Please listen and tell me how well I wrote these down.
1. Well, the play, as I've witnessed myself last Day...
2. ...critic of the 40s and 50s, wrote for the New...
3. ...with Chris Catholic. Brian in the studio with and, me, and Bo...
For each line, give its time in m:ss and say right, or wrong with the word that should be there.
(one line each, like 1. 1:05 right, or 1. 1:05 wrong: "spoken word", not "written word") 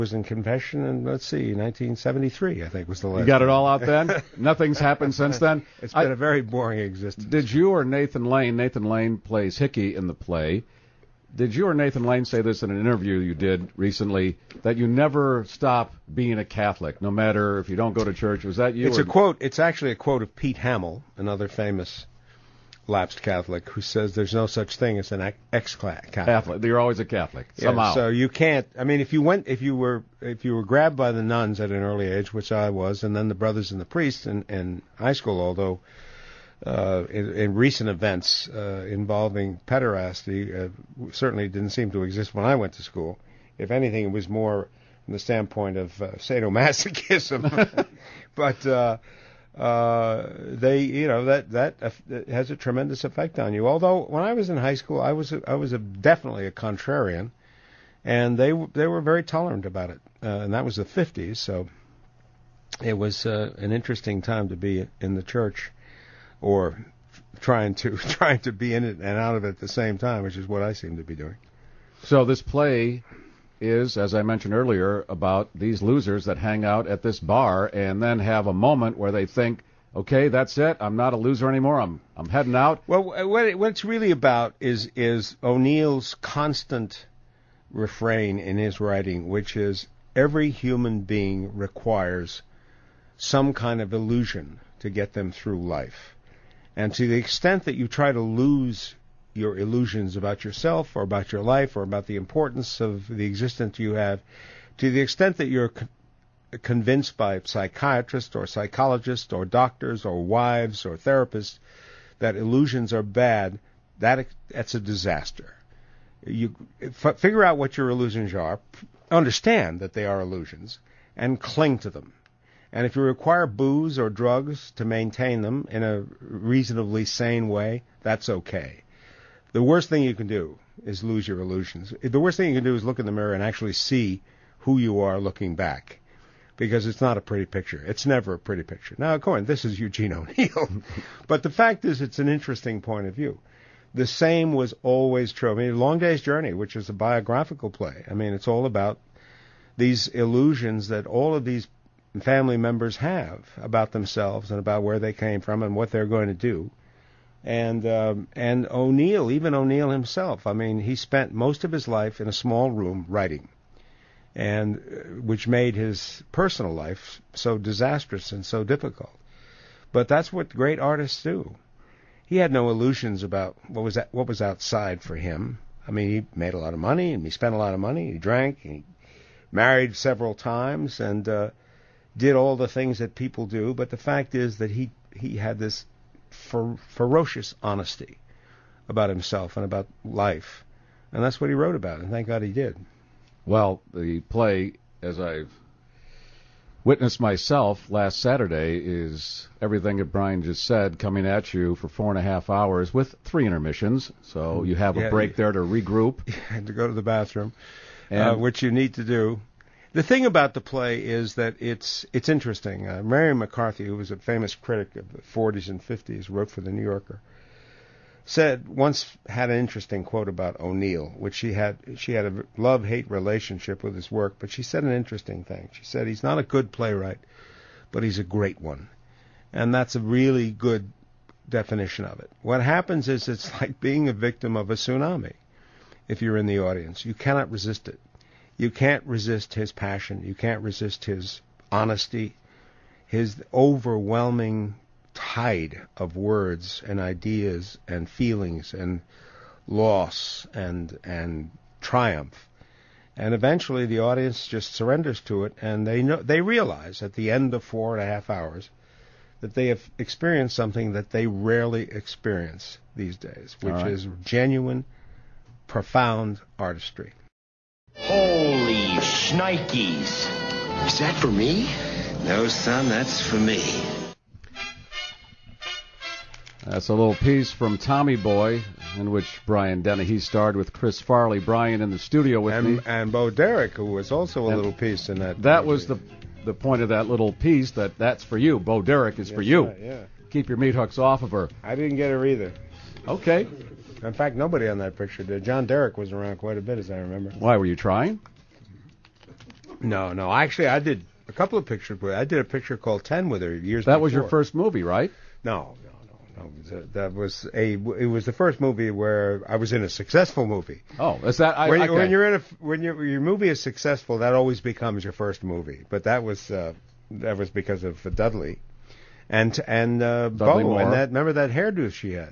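1. 3:13 wrong: "Saturday", not "Day"
2. 3:34 right
3. 4:40 wrong: "Farley", not "Catholic".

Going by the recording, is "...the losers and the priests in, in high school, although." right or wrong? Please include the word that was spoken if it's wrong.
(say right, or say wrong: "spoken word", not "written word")
wrong: "brothers", not "losers".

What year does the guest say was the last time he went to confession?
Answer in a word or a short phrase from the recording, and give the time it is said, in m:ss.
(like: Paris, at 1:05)
1973, at 0:01.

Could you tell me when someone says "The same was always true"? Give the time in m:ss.
2:23.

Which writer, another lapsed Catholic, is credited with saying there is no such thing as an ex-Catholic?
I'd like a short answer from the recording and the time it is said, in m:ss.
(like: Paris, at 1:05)
Pete Hamill, at 0:20.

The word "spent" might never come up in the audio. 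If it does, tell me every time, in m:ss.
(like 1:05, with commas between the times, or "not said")
2:40, 2:57.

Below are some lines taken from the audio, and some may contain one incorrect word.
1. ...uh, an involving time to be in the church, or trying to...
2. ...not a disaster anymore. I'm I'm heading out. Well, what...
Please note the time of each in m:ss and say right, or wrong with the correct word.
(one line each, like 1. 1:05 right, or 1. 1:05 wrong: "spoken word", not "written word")
1. 1:03 wrong: "interesting", not "involving"
2. 1:20 wrong: "loser", not "disaster".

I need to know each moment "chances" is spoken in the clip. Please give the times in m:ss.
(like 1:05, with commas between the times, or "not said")
not said.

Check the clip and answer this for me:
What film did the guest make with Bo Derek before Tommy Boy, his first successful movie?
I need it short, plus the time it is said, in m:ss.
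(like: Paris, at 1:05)
Ten, at 5:03.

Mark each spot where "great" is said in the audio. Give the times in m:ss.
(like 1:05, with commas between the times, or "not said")
2:50, 3:48.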